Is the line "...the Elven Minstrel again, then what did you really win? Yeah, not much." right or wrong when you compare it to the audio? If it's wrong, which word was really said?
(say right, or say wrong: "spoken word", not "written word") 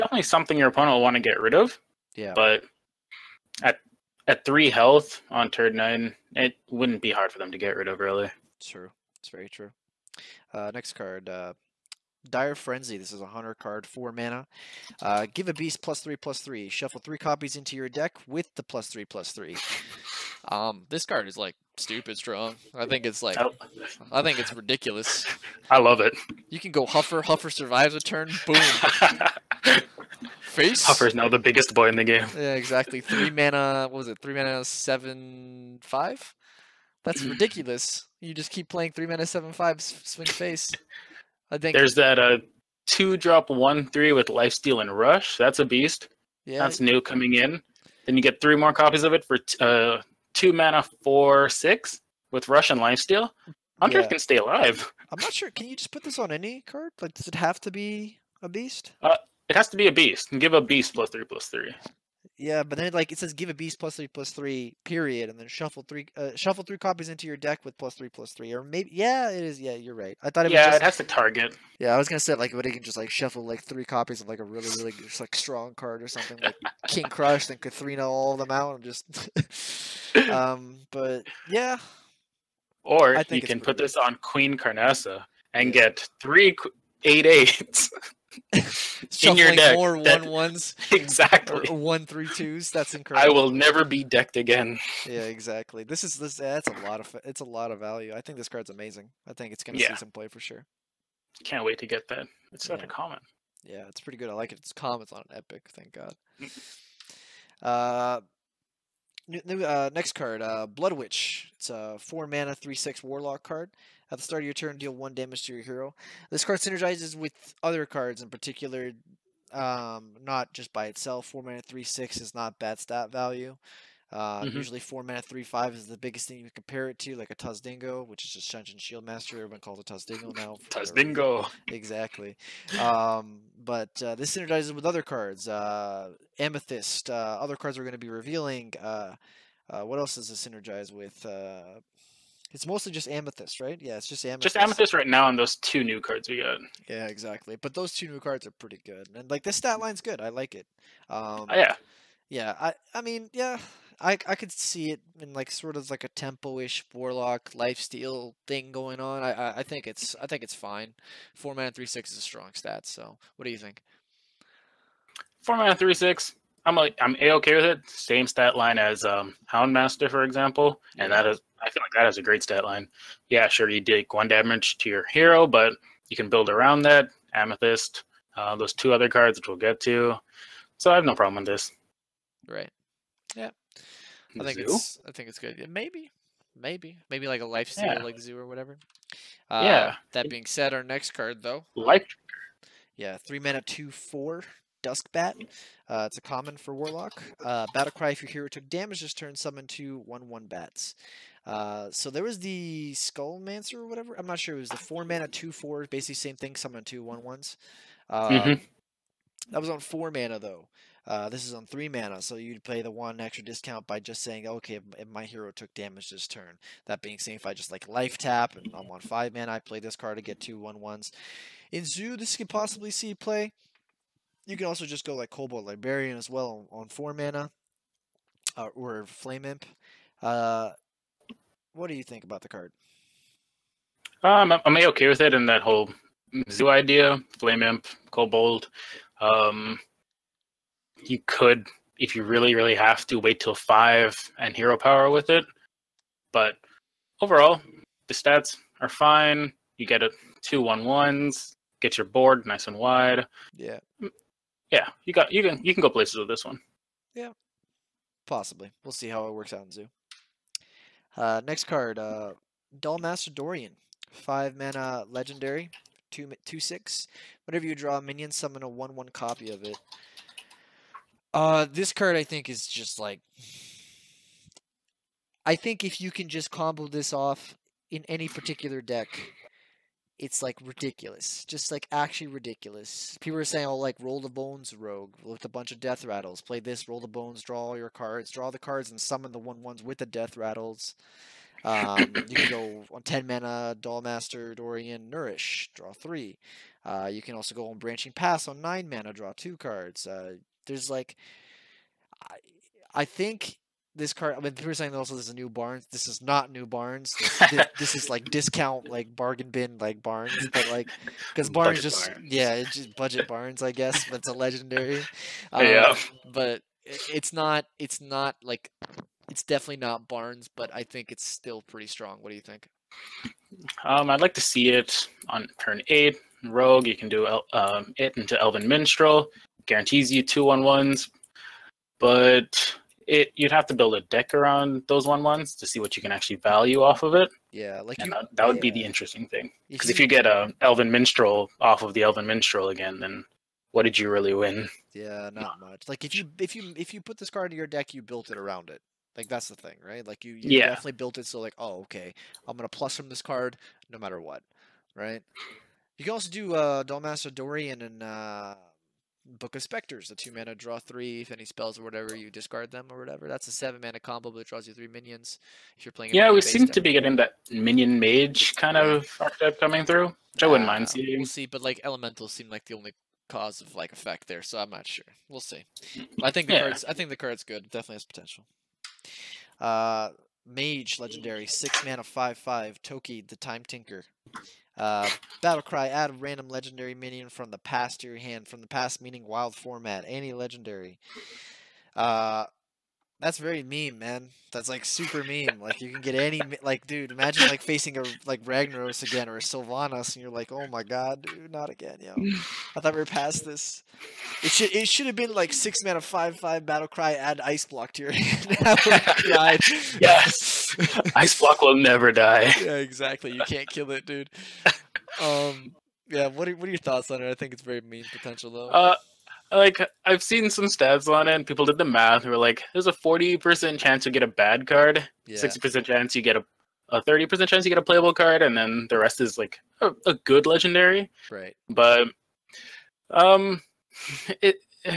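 right.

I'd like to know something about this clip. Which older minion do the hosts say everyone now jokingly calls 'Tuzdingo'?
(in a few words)
Sen'jin Shieldmasta.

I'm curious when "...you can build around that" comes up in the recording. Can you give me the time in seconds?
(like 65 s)
176 s.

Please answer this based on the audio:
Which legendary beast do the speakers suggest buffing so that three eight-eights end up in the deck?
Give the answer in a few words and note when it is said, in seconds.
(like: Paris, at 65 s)
Queen Carnassa, at 84 s.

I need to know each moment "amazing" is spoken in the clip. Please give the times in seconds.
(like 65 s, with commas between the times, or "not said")
98 s.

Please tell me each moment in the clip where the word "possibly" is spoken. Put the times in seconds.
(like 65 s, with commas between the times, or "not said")
222 s, 258 s.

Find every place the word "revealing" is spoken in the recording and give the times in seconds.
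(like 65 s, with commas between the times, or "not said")
138 s.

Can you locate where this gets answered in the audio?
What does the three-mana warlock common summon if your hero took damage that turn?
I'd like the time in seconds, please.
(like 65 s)
199 s.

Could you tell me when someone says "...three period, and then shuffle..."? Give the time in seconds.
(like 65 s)
64 s.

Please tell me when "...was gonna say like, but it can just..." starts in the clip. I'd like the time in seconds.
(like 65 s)
71 s.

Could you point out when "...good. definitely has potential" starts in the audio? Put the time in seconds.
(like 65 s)
377 s.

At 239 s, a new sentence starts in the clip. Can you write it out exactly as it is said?
Um, you could, if you really, really have to, wait till five and hero power with it.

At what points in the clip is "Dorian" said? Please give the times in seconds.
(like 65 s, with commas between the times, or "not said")
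263 s, 294 s, 357 s.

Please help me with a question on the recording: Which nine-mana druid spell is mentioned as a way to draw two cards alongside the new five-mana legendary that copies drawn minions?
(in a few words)
Branching Paths.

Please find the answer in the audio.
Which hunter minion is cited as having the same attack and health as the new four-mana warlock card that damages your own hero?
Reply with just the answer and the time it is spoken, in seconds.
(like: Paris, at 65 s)
Houndmaster, at 169 s.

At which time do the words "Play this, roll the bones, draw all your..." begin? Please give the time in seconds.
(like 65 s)
286 s.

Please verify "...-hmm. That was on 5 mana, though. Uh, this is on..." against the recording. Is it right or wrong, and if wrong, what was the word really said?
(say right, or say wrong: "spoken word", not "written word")
wrong: "4", not "5".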